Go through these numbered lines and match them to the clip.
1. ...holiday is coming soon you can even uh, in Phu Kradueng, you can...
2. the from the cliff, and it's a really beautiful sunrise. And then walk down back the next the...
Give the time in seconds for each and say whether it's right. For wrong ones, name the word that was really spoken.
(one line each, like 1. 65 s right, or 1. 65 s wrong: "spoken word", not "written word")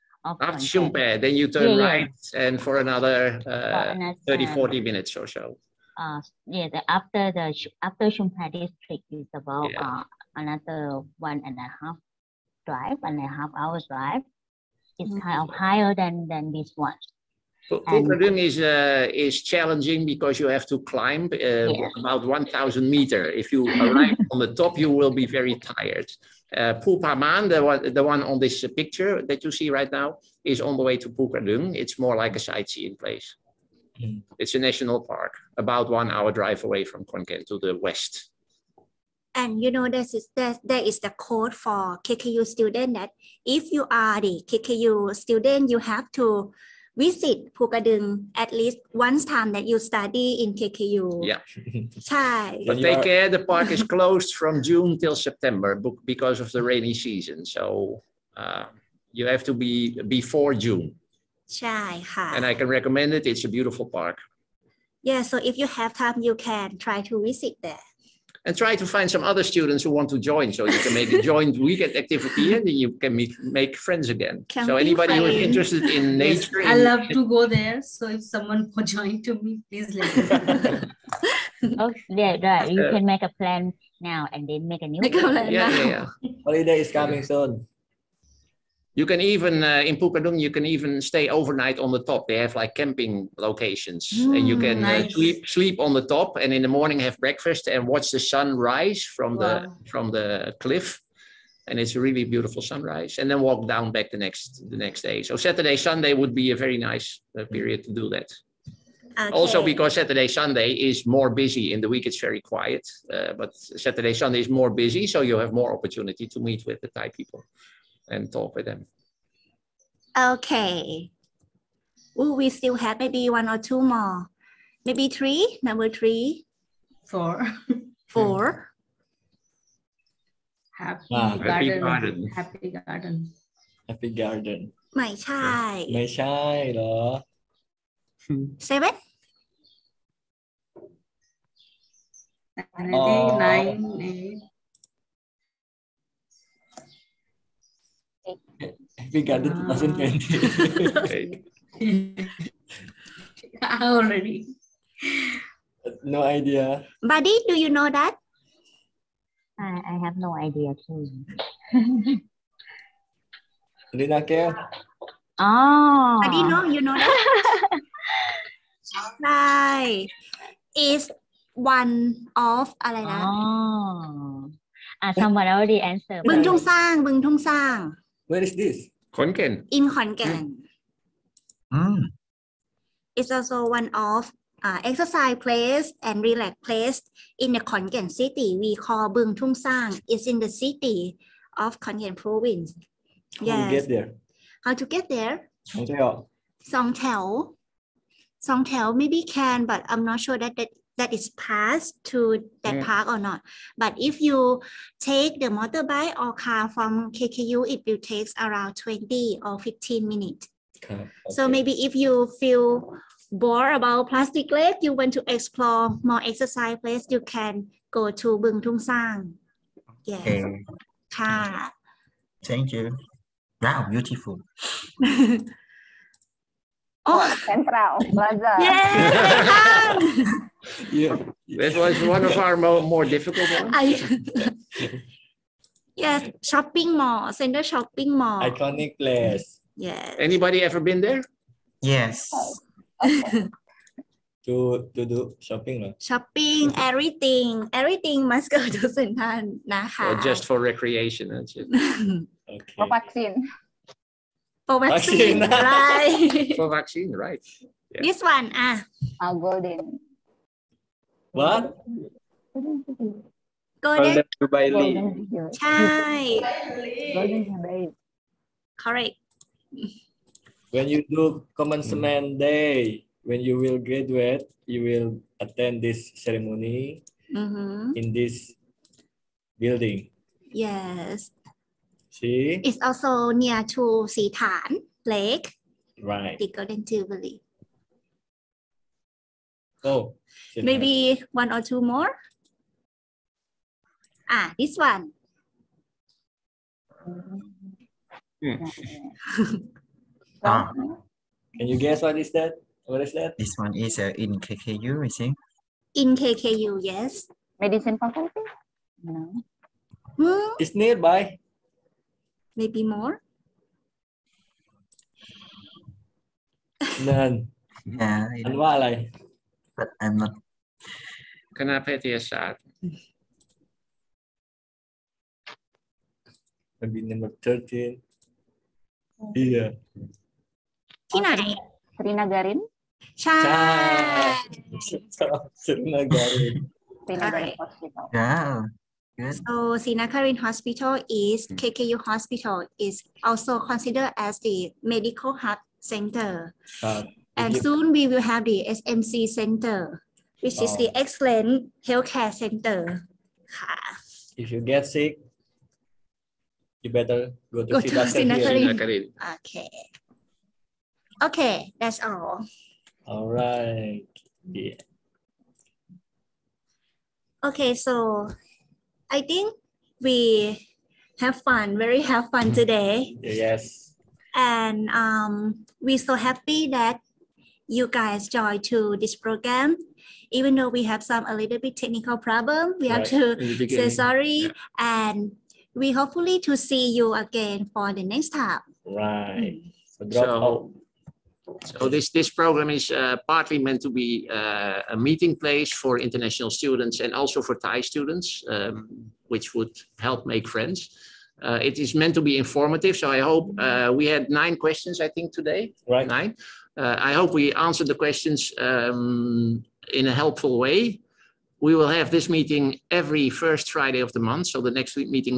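1. 86 s right
2. 99 s right.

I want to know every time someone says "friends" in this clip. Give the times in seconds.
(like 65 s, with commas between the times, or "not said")
73 s, 400 s.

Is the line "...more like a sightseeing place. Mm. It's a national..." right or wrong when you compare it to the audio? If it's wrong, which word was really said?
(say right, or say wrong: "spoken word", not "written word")
right.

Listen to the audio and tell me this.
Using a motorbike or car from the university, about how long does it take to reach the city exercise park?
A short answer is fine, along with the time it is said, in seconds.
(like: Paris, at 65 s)
20 or 15 minutes, at 208 s.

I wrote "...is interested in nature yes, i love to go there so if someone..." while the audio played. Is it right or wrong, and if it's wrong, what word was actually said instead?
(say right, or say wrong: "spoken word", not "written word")
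right.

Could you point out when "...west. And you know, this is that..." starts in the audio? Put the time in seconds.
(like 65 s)
37 s.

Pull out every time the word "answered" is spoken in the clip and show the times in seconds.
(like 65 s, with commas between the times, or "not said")
175 s, 407 s.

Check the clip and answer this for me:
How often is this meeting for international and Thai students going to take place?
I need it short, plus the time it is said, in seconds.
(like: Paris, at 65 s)
Every first Friday of the month, at 412 s.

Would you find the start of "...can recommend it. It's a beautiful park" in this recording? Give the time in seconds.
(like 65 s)
62 s.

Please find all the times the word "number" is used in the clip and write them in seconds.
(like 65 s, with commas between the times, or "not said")
125 s, 327 s.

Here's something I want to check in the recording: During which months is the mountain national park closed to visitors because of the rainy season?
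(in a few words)
June till September.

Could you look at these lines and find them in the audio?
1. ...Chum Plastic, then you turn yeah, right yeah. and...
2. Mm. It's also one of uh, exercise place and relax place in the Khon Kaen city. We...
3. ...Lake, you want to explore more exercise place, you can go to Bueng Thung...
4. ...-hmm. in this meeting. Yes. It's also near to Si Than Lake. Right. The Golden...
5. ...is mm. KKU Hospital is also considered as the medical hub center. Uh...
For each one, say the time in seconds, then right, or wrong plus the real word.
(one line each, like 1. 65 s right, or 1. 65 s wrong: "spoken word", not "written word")
1. 0 s wrong: "Phae", not "Plastic"
2. 181 s right
3. 214 s right
4. 277 s wrong: "building", not "meeting"
5. 341 s right.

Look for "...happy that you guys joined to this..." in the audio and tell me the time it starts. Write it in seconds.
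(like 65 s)
376 s.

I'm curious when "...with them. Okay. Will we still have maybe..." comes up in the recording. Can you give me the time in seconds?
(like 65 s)
118 s.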